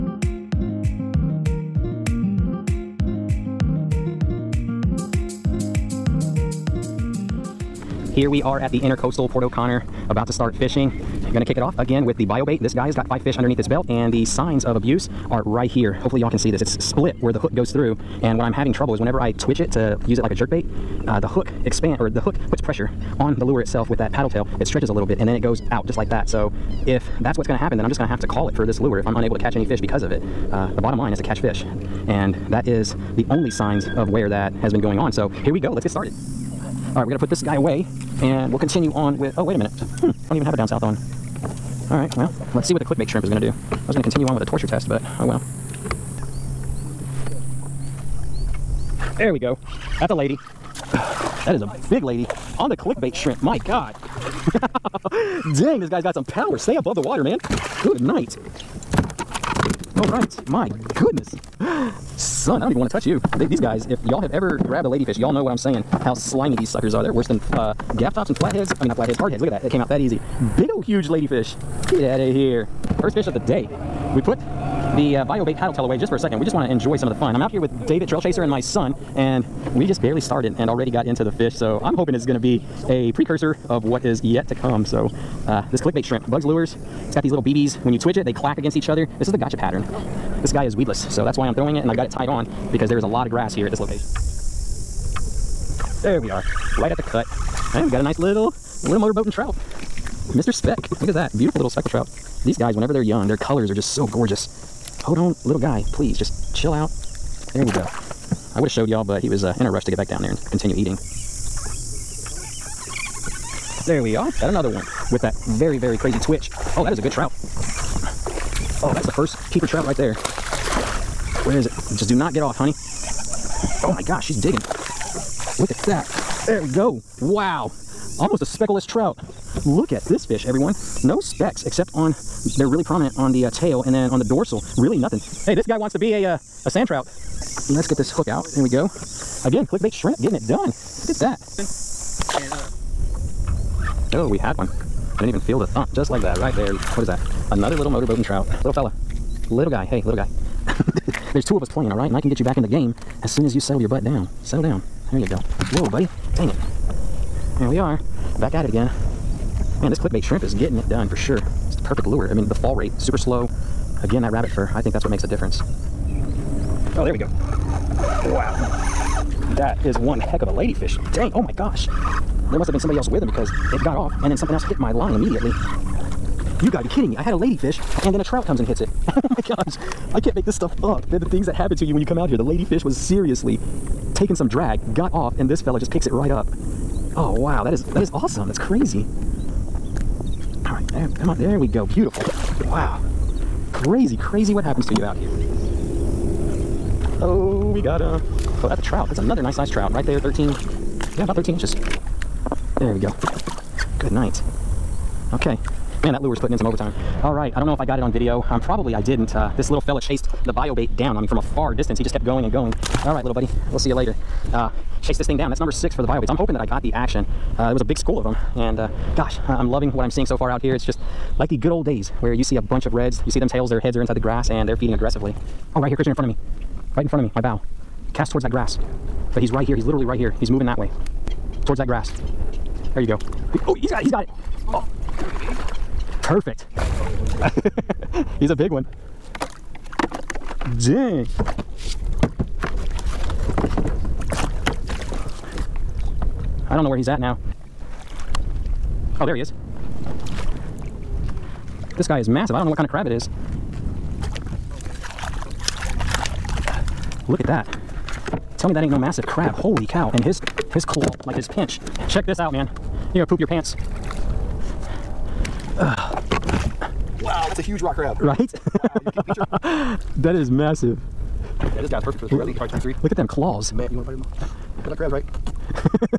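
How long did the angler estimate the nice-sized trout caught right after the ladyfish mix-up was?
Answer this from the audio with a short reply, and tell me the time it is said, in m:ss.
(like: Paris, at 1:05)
13 inches, at 3:21.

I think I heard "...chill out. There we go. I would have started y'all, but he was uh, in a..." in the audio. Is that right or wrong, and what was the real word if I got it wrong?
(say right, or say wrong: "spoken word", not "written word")
wrong: "showed", not "started".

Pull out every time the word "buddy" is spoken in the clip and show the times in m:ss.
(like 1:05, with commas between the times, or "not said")
2:35, 3:33.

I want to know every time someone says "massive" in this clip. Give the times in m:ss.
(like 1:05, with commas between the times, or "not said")
4:12, 4:18, 4:30.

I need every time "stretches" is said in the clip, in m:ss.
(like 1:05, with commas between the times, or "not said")
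0:24.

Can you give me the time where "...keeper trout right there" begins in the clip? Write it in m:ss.
1:59.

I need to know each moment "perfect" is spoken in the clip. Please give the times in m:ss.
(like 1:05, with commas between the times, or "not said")
2:41, 3:56, 4:32.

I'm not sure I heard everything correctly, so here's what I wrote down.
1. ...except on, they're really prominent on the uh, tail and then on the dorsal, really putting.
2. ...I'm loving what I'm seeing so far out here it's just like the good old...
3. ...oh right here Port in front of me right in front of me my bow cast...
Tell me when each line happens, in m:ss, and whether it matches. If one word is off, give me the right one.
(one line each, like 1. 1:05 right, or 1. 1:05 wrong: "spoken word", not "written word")
1. 2:11 wrong: "nothing", not "putting"
2. 3:39 right
3. 3:45 wrong: "Christian", not "Port".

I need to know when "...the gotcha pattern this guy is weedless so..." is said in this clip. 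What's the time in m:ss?
1:29.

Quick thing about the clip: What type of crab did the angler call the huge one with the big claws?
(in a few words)
Rock crab.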